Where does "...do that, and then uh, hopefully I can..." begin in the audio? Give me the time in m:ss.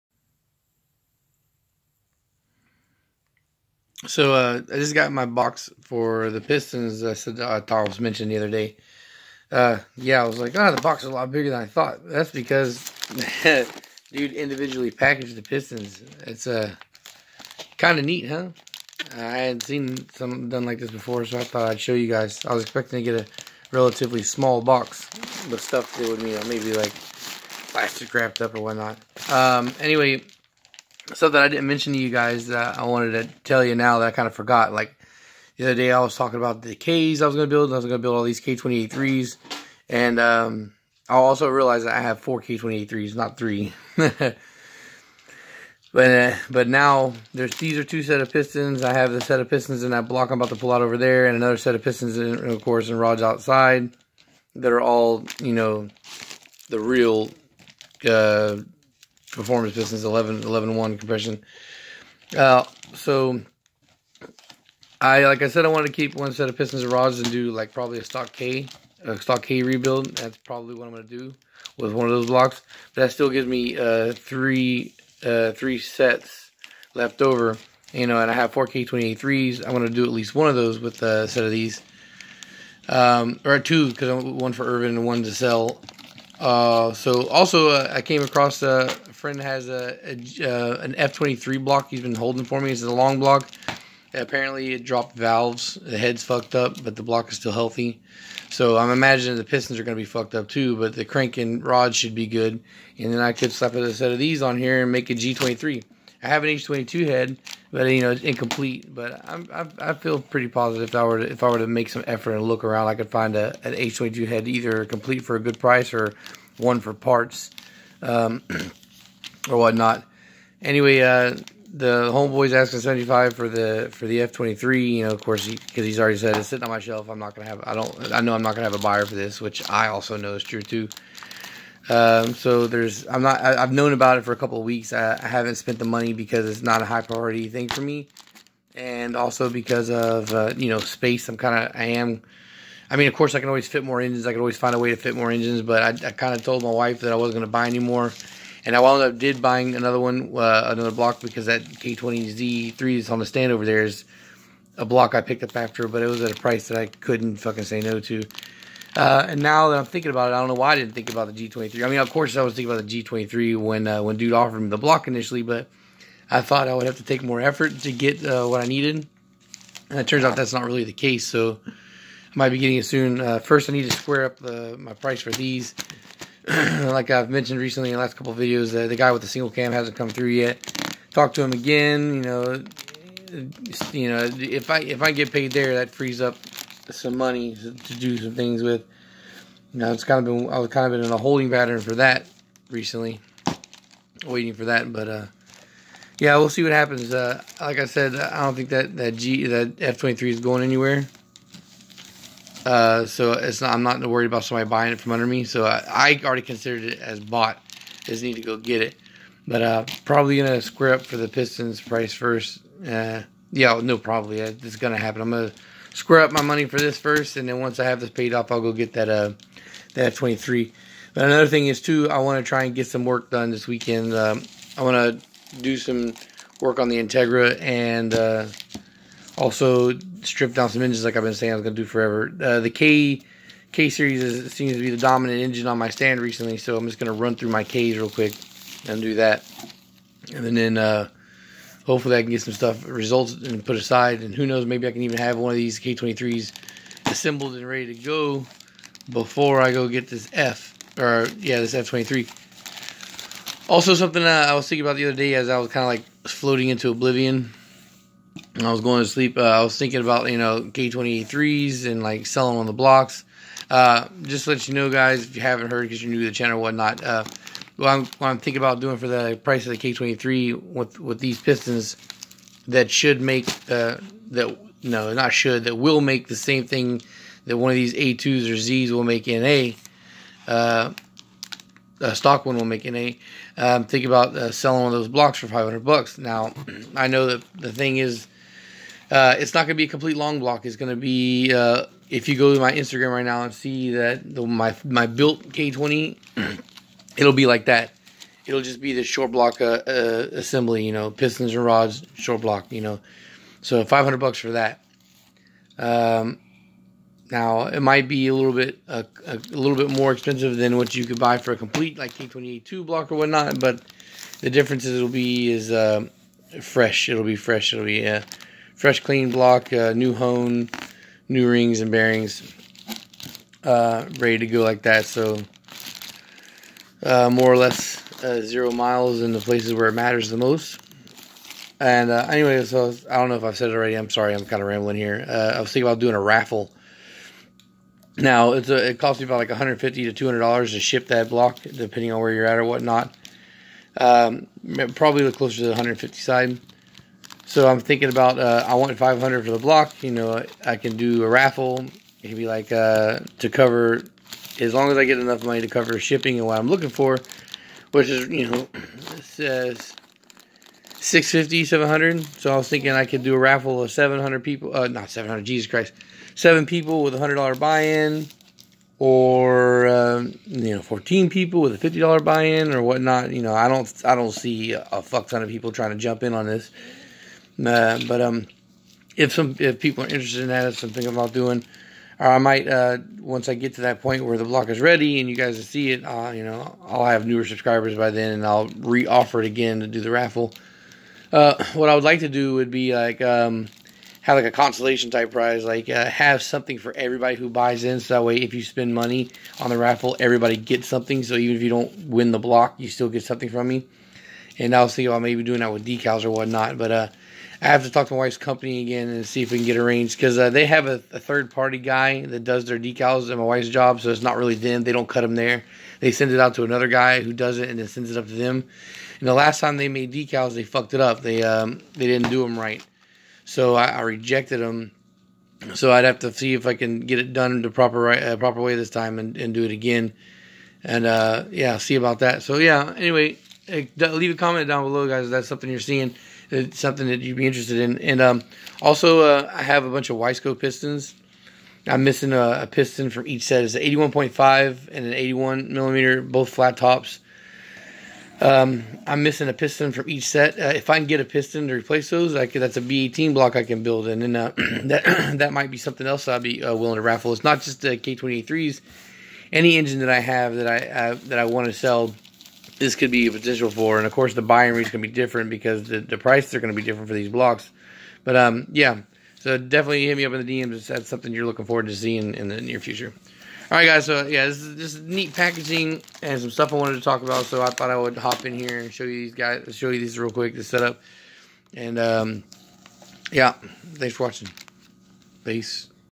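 3:59.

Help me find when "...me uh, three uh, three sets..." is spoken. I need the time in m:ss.
1:13.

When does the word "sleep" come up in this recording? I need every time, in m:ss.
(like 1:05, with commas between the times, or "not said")
4:19.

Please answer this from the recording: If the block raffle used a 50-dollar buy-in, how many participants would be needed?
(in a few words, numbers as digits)
14.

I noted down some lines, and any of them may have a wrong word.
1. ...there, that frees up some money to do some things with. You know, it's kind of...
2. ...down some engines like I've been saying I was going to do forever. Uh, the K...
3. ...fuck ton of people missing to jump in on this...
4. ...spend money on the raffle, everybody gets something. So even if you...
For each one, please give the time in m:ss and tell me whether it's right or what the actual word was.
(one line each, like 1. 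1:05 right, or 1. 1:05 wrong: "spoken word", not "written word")
1. 3:05 right
2. 3:50 right
3. 6:15 wrong: "trying", not "missing"
4. 6:38 right.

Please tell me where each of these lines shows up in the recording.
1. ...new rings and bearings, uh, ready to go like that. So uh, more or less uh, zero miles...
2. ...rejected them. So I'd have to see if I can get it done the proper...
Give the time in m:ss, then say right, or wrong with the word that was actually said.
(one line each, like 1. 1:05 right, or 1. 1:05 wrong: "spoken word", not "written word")
1. 5:21 right
2. 7:04 right.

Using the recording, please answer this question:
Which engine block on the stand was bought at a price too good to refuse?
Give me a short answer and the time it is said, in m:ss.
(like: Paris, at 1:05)
K20Z3, at 2:31.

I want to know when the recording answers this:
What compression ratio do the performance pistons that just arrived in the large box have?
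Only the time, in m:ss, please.
1:00.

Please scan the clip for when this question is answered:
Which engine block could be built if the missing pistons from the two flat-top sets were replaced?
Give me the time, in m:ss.
7:32.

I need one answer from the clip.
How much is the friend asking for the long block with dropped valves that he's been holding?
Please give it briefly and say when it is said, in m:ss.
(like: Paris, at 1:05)
75, at 2:02.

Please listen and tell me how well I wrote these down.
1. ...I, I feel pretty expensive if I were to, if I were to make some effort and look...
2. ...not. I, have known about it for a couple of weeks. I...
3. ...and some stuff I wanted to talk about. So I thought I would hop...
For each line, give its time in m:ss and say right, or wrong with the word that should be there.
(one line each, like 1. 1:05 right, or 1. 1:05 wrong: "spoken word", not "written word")
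1. 1:49 wrong: "positive", not "expensive"
2. 2:13 right
3. 7:56 right.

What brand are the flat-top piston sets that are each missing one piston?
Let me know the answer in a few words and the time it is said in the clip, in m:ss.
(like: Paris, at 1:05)
Wiseco, at 7:20.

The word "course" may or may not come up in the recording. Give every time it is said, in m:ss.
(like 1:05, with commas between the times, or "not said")
0:52, 2:05, 2:23, 2:42, 7:44.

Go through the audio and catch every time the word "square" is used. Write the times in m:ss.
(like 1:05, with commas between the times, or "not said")
2:53, 3:30, 3:35.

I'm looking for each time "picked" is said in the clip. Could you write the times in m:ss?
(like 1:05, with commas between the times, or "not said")
2:35.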